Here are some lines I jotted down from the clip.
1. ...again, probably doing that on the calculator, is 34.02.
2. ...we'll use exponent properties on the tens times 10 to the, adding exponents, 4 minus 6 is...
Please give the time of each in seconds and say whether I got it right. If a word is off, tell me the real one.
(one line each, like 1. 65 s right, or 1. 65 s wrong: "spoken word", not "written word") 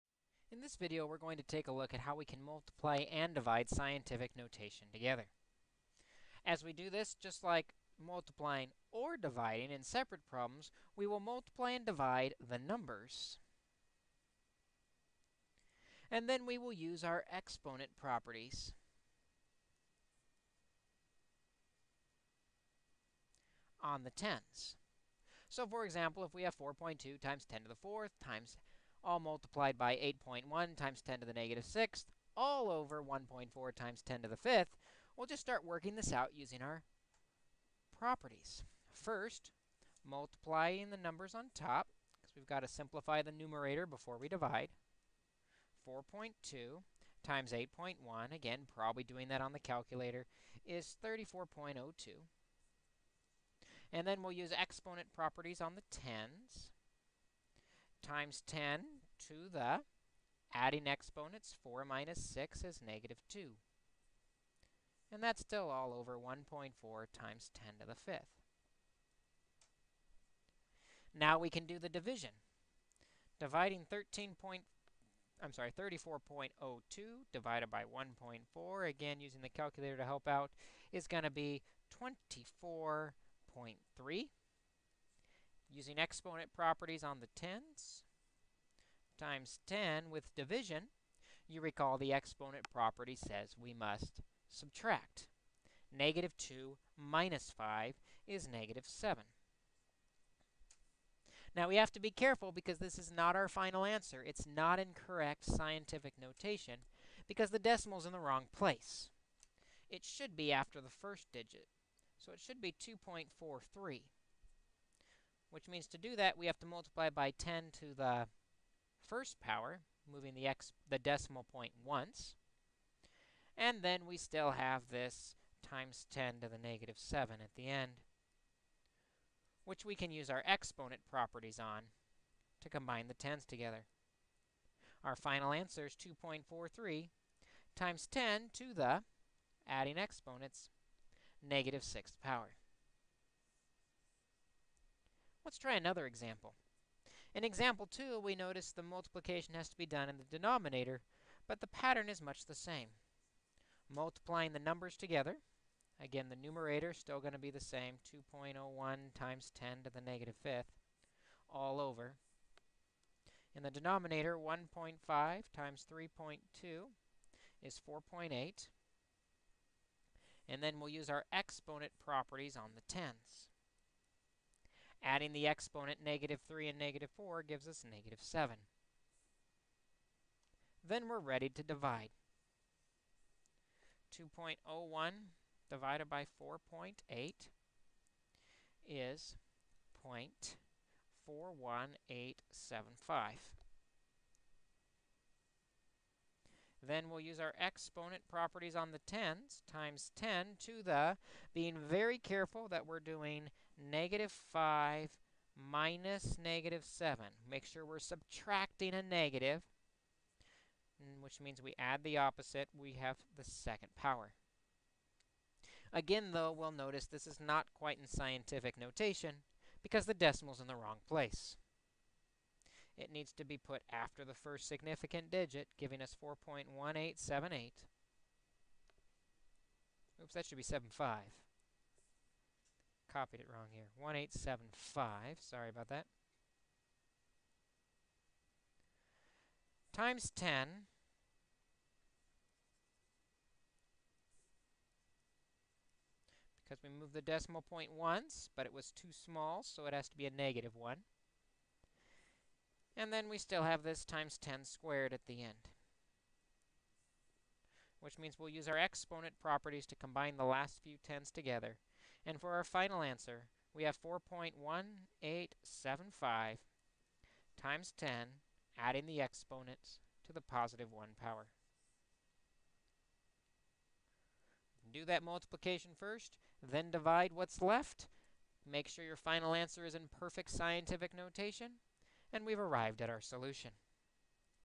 1. 48 s right
2. 54 s right.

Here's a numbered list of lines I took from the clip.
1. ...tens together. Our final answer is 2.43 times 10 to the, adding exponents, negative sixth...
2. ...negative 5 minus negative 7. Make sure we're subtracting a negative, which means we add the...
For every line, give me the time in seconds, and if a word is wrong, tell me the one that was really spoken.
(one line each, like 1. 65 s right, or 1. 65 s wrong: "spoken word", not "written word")
1. 133 s right
2. 203 s right.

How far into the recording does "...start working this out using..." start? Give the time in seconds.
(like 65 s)
35 s.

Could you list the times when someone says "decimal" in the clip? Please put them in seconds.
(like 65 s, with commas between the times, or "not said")
107 s, 120 s, 220 s, 247 s.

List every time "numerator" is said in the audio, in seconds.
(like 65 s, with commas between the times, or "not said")
43 s, 156 s.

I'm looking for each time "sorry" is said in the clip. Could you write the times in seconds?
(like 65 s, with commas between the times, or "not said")
75 s, 235 s.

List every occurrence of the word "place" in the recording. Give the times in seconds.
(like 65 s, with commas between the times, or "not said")
108 s, 221 s.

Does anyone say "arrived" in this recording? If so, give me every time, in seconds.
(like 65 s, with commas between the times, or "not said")
282 s.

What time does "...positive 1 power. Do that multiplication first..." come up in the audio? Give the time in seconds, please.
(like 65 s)
270 s.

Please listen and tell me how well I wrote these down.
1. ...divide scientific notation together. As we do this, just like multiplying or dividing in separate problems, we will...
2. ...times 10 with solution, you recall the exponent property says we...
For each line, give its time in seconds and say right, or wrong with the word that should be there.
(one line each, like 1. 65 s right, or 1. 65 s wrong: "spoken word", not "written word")
1. 3 s right
2. 89 s wrong: "division", not "solution".